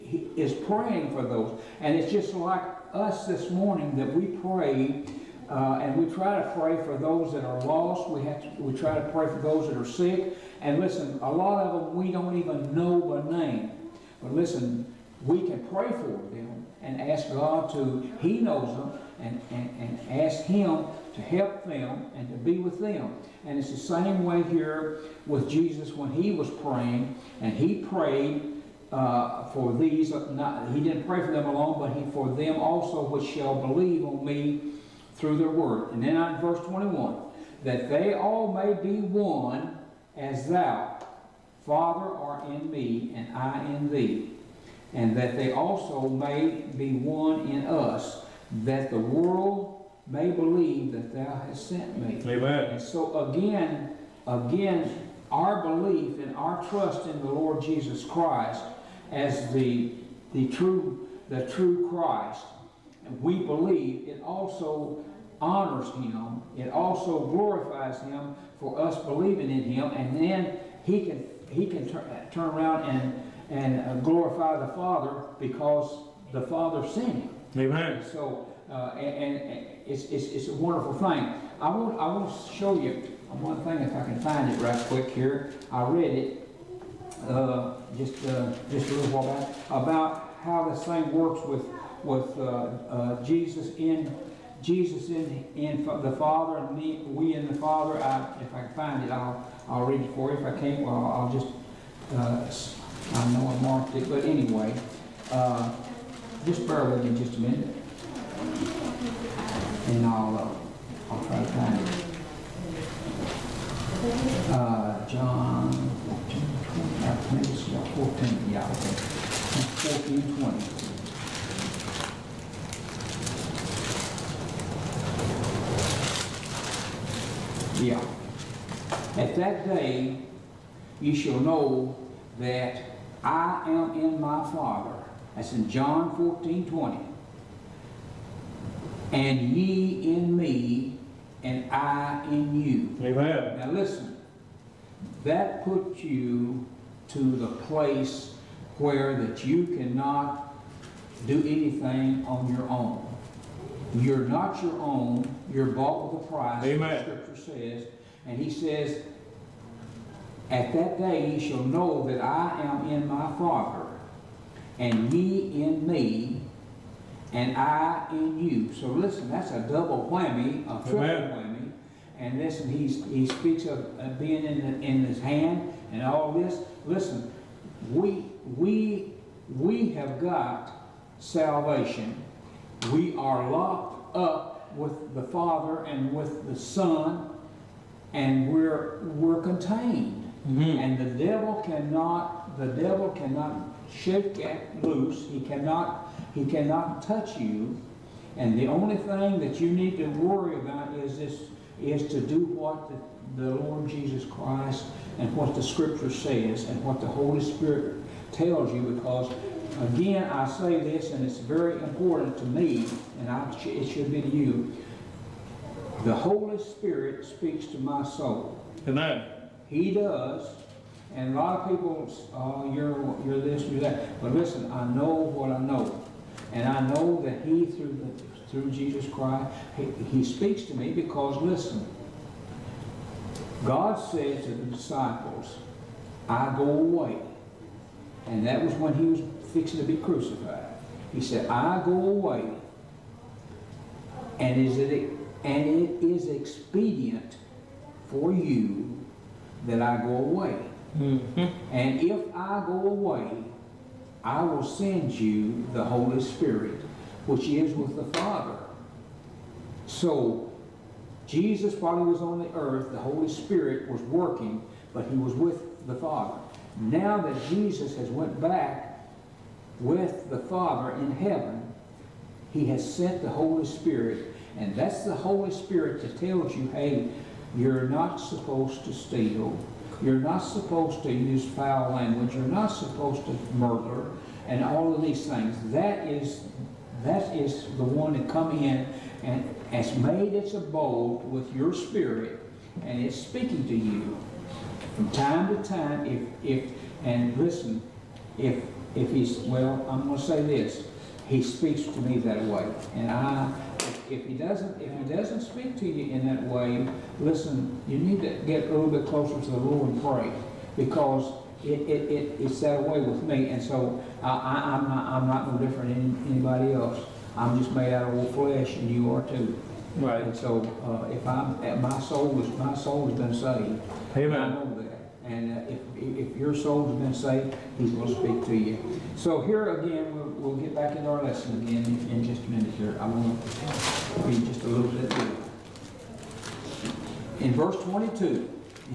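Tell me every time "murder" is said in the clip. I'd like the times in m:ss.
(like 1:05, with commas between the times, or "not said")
4:43.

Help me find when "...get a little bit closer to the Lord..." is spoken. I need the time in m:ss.
5:08.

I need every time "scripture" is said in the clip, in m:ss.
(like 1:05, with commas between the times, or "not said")
2:37, 3:25.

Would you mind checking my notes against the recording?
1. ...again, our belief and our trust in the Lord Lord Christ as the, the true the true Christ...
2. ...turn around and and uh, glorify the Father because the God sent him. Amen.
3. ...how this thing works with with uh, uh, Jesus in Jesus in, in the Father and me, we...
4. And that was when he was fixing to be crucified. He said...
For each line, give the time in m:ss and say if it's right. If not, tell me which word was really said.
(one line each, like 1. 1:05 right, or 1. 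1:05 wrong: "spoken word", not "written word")
1. 0:54 wrong: "Jesus", not "Lord"
2. 1:12 wrong: "Father", not "God"
3. 1:30 right
4. 3:58 right.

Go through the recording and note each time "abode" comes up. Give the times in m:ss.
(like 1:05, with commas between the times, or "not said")
4:50.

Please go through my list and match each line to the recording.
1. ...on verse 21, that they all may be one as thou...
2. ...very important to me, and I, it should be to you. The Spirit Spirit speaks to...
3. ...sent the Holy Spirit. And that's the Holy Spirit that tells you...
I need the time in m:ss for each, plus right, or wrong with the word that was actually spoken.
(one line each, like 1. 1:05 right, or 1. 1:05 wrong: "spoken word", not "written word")
1. 0:36 right
2. 3:31 wrong: "Holy", not "Spirit"
3. 4:32 right.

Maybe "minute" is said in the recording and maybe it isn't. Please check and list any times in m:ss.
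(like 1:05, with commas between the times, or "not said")
1:47, 5:32.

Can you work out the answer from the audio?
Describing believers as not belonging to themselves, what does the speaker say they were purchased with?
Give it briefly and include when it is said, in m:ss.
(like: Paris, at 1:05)
a price, at 2:36.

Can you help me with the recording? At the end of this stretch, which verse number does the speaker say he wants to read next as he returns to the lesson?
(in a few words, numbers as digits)
22.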